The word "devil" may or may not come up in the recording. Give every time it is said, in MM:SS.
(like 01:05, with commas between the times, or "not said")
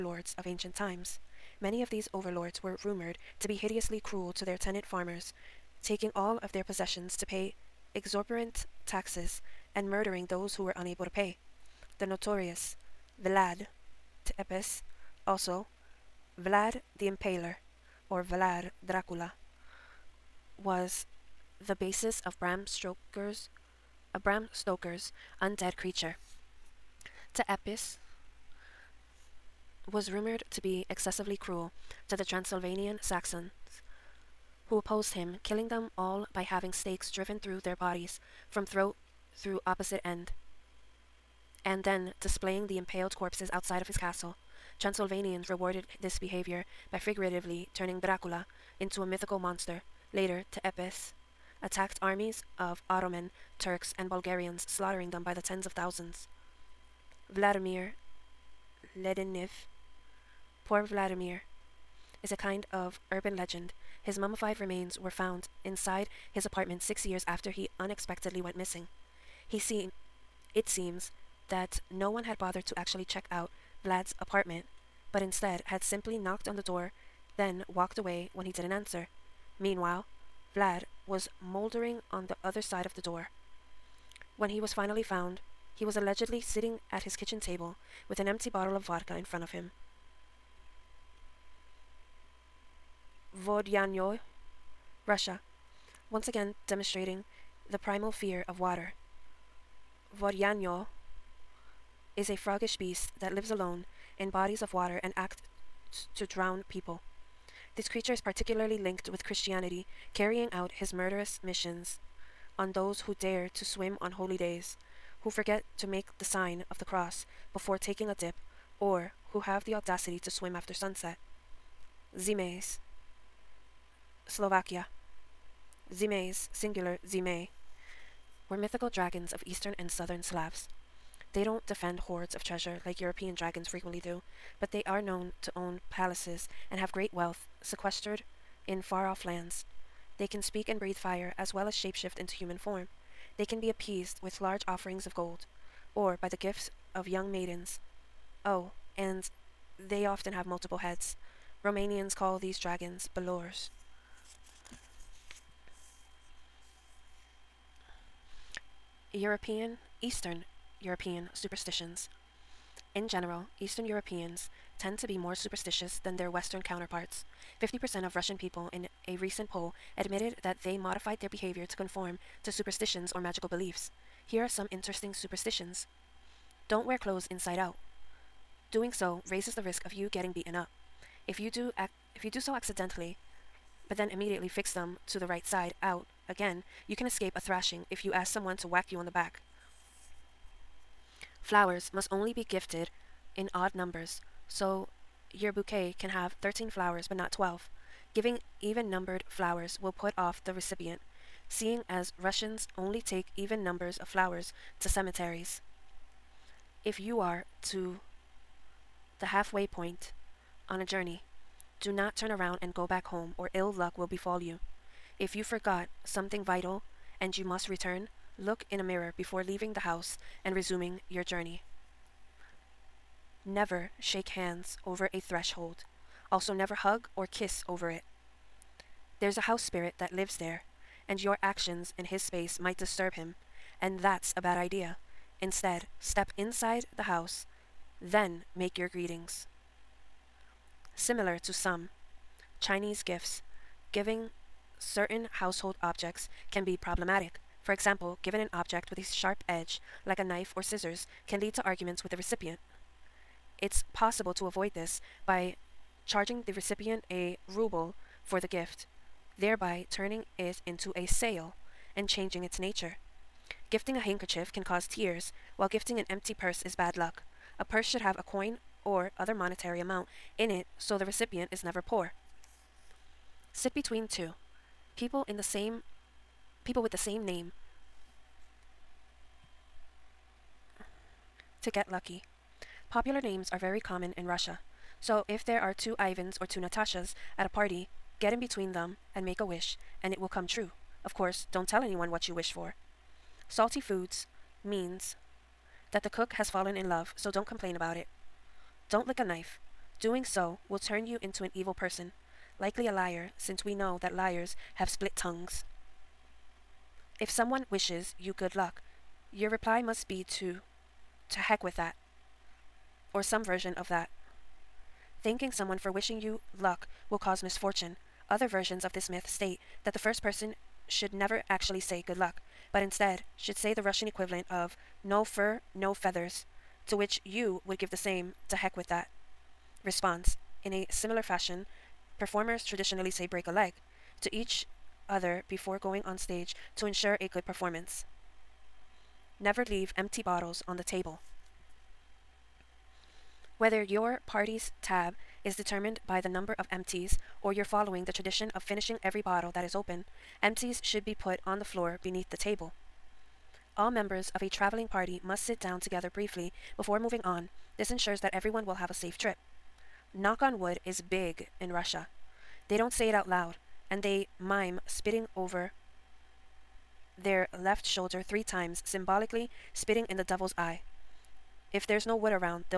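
06:10.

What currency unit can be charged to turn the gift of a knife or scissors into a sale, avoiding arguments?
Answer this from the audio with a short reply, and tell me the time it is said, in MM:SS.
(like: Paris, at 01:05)
ruble, at 04:17.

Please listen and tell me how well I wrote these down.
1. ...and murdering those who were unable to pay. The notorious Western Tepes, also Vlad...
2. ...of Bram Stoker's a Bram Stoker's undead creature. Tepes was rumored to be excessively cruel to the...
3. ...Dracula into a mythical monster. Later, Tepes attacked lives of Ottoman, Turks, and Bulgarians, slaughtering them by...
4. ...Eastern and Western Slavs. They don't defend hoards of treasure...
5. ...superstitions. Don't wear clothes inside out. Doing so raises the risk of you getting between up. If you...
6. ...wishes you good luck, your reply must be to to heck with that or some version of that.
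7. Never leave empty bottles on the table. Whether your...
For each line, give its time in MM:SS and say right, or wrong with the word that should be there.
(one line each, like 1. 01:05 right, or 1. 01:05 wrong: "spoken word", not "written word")
1. 00:09 wrong: "Vlad", not "Western"
2. 00:22 right
3. 00:48 wrong: "armies", not "lives"
4. 02:09 wrong: "Southern", not "Western"
5. 02:55 wrong: "beaten", not "between"
6. 05:07 right
7. 05:39 right.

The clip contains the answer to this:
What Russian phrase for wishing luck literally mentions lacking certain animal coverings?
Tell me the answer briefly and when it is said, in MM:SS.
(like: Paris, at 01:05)
no fur, no feathers, at 05:25.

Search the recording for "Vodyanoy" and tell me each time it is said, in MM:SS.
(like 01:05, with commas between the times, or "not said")
01:33, 01:40.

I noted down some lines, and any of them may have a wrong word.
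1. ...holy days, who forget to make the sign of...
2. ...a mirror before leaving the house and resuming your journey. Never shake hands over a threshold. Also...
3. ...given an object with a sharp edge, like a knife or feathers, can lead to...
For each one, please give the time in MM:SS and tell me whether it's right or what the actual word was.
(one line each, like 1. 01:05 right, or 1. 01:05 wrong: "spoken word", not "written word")
1. 01:54 right
2. 03:38 right
3. 04:08 wrong: "scissors", not "feathers".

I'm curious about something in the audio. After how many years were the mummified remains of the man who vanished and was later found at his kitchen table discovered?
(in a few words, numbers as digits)
6.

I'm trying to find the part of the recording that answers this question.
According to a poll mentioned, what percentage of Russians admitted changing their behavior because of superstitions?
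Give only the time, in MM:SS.
02:47.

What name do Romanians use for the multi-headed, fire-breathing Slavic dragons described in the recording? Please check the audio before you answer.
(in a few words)
balaurs.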